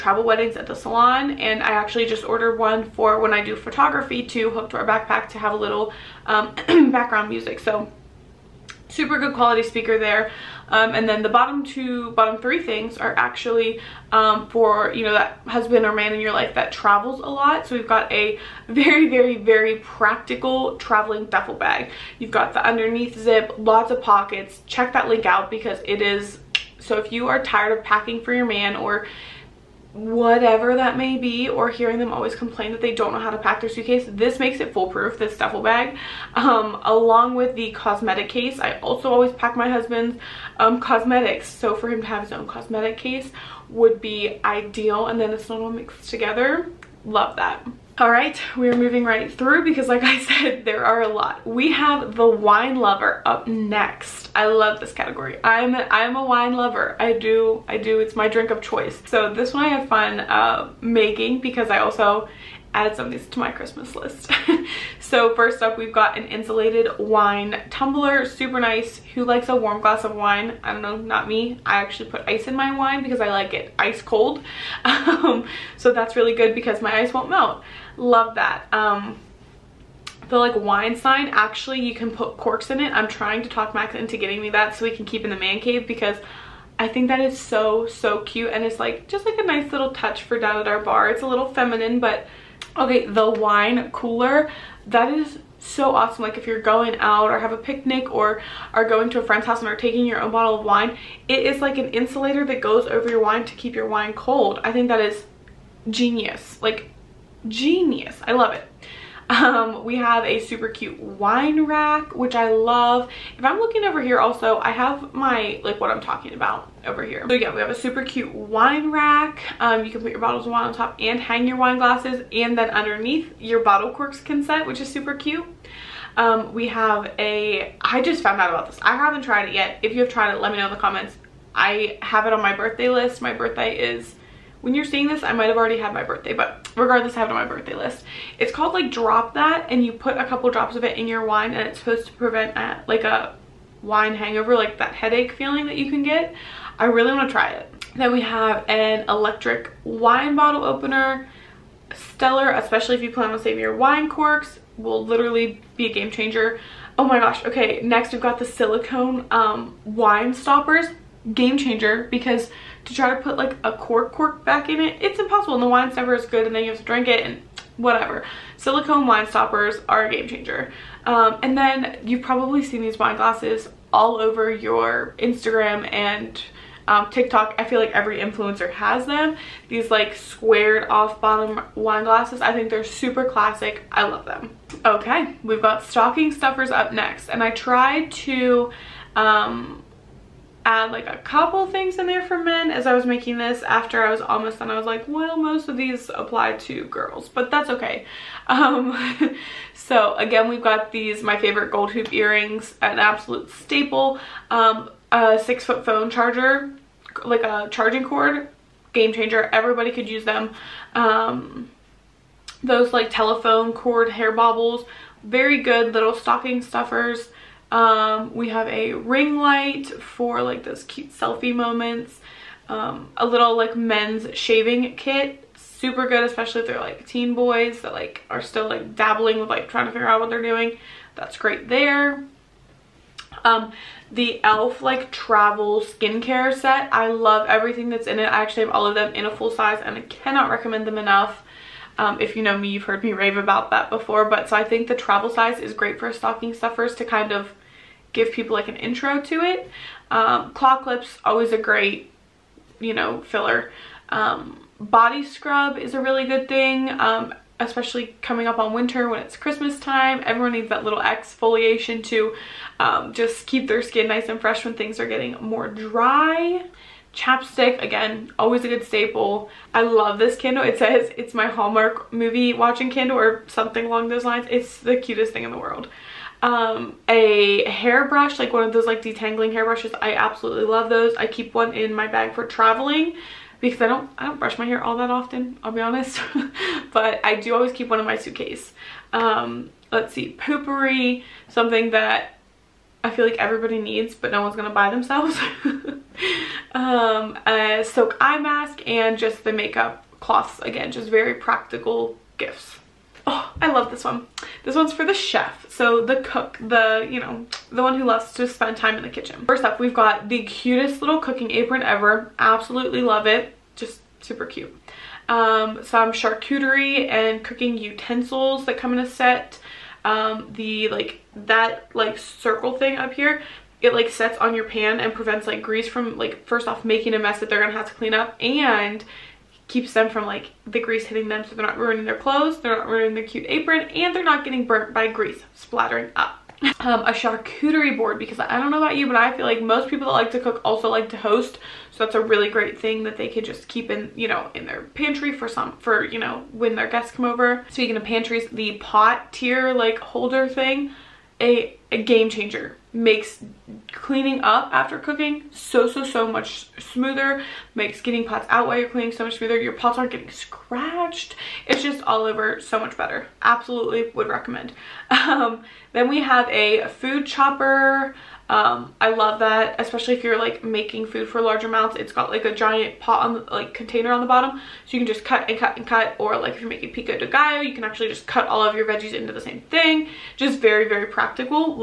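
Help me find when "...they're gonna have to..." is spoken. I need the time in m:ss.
5:27.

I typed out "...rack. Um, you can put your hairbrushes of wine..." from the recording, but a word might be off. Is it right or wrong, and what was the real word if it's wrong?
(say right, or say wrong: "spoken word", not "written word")
wrong: "bottles", not "hairbrushes".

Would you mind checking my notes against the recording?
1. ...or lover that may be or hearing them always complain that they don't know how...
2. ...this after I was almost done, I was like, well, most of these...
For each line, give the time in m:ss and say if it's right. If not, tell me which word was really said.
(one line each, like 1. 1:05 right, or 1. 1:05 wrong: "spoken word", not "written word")
1. 0:28 wrong: "whatever", not "lover"
2. 3:13 right.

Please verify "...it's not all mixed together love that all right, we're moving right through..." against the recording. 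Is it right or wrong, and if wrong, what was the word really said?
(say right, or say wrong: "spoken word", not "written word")
right.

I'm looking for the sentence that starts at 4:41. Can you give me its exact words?
I keep one in my bag for traveling because I don't, I don't brush my hair all that often, I'll be honest.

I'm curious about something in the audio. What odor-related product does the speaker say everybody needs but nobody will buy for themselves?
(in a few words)
Poo-Pourri.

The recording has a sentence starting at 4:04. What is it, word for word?
But so I think the travel size is great for stocking stuffers to kind of give people like an intro to it.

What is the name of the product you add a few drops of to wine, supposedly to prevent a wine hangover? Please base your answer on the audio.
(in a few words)
Drop That.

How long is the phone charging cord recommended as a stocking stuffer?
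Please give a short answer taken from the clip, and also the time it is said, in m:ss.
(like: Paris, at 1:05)
6 feet, at 3:25.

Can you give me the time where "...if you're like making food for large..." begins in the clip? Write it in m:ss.
6:10.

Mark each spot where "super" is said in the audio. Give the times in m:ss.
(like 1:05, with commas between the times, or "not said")
0:08, 1:08, 1:50, 1:57, 2:04, 3:02, 3:45, 5:14.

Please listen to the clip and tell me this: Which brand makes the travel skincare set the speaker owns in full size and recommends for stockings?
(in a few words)
e.l.f.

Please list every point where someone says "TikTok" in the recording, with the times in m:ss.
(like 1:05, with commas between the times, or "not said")
2:57.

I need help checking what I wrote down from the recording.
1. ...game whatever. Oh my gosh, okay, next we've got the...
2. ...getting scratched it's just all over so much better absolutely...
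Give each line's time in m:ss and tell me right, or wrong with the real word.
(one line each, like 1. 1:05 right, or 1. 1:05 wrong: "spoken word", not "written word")
1. 2:35 wrong: "changer", not "whatever"
2. 6:00 right.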